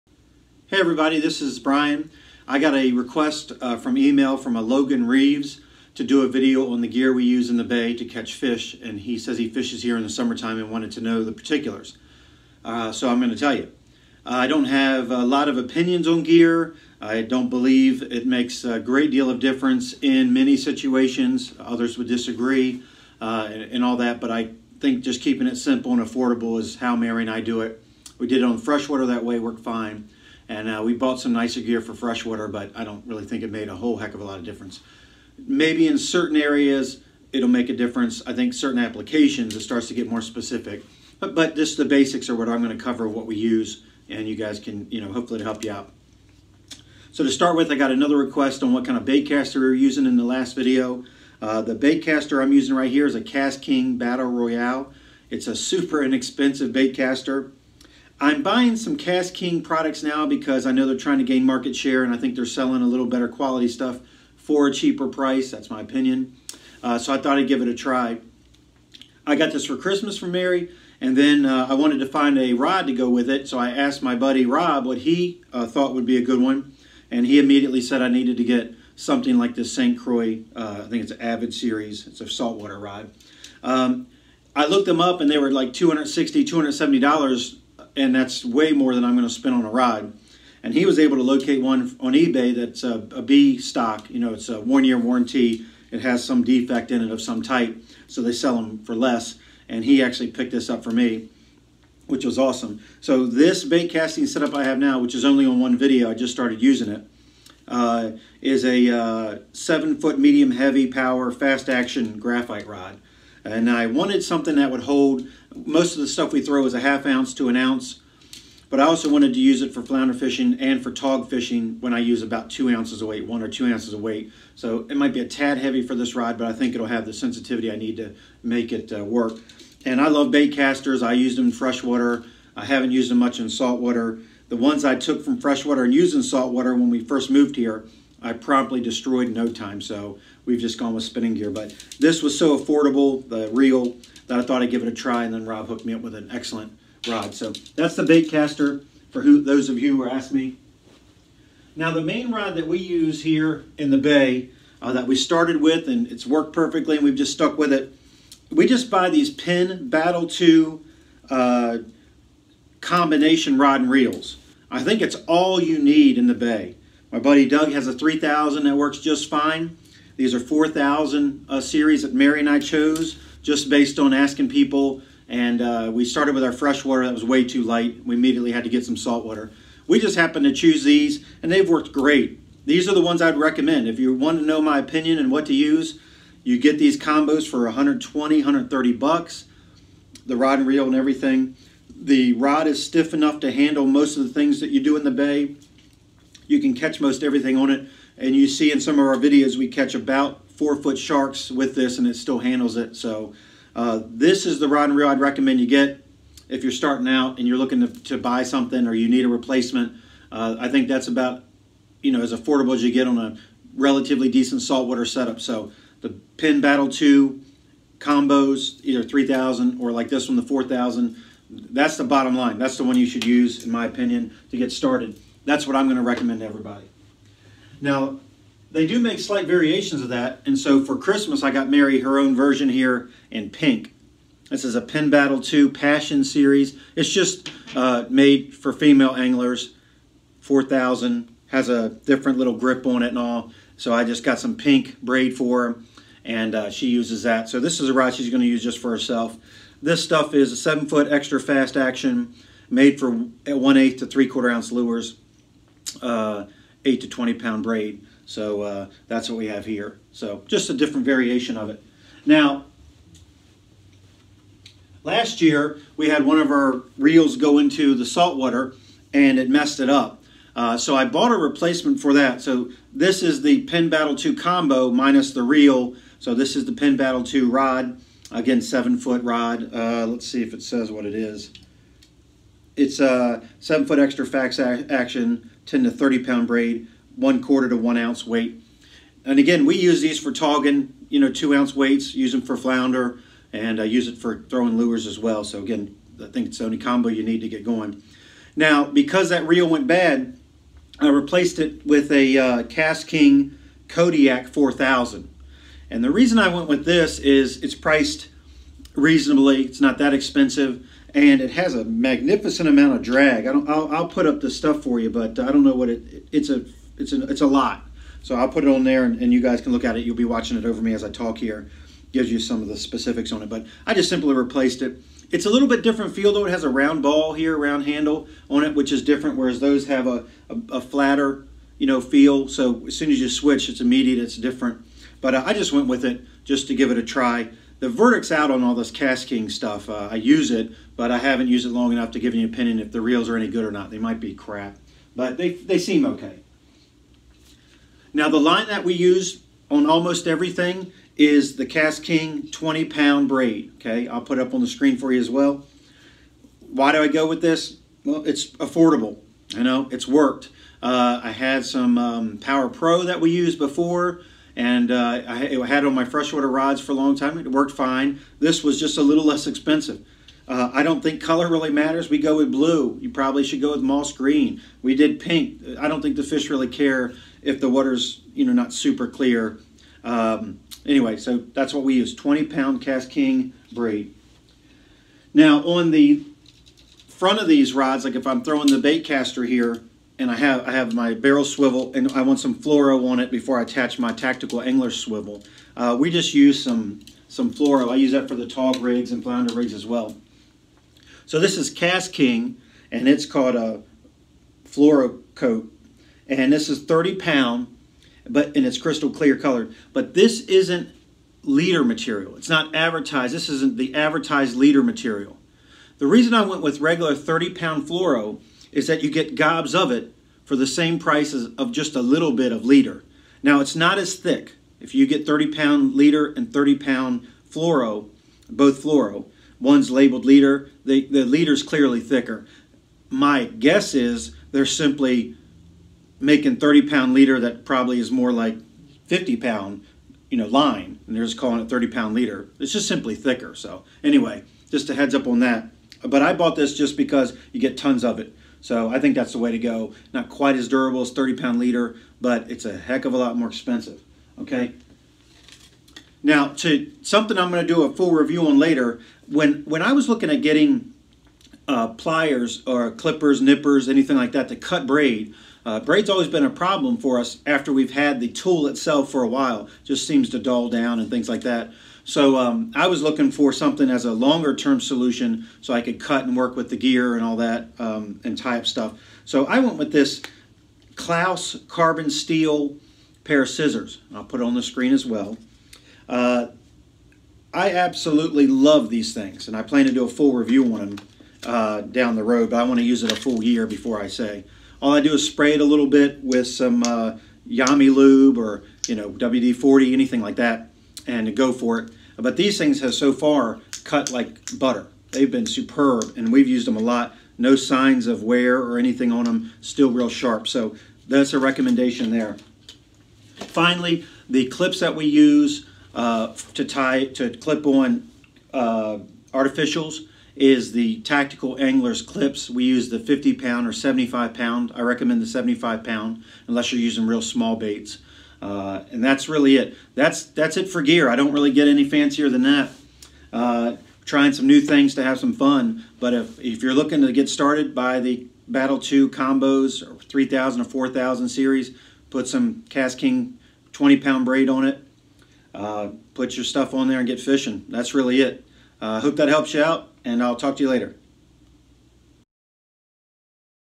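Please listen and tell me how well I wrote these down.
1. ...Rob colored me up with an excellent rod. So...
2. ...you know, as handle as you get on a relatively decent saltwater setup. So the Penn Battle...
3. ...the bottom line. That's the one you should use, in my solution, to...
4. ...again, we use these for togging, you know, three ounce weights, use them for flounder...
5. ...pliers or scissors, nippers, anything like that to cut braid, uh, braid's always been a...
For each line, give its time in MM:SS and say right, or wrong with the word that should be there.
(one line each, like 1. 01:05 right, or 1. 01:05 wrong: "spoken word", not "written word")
1. 02:25 wrong: "hooked", not "colored"
2. 03:32 wrong: "affordable", not "handle"
3. 03:41 wrong: "opinion", not "solution"
4. 04:49 wrong: "two", not "three"
5. 07:41 wrong: "clippers", not "scissors".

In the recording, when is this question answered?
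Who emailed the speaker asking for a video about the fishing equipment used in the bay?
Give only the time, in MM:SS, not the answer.
00:04.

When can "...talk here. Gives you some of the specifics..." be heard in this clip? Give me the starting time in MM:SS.
05:21.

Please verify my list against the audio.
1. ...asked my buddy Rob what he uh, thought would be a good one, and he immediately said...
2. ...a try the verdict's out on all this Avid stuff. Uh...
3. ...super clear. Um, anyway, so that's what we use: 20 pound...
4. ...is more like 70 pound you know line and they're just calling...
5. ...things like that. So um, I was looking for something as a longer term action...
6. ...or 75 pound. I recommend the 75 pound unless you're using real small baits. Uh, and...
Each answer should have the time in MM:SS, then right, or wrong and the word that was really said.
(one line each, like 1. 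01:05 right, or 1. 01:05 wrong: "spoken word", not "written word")
1. 01:13 right
2. 05:36 wrong: "KastKing", not "Avid"
3. 06:18 right
4. 07:17 wrong: "50", not "70"
5. 07:51 wrong: "solution", not "action"
6. 08:43 right.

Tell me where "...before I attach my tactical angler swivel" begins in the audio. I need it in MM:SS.
06:33.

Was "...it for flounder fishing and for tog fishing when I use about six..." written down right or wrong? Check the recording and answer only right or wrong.
wrong.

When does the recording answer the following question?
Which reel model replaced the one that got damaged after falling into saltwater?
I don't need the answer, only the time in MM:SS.
05:02.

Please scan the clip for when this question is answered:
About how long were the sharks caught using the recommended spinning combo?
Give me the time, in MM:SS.
03:20.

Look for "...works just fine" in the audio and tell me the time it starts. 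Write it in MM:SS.
02:48.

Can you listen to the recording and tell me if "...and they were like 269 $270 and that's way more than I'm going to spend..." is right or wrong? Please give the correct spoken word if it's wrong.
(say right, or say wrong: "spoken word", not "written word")
wrong: "260", not "269".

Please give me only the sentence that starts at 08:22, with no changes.
But these things have so far cut like butter.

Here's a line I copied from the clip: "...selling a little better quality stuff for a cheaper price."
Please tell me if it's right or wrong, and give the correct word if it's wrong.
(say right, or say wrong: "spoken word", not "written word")
right.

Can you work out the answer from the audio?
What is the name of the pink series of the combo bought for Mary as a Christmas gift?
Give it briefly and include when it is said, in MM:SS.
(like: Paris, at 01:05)
Passion Series, at 03:55.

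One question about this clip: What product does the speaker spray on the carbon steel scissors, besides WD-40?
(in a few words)
Yamalube.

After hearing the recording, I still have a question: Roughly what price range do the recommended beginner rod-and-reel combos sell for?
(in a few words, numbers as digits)
$120-130.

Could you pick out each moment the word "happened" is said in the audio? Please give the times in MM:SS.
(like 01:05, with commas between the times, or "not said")
03:00.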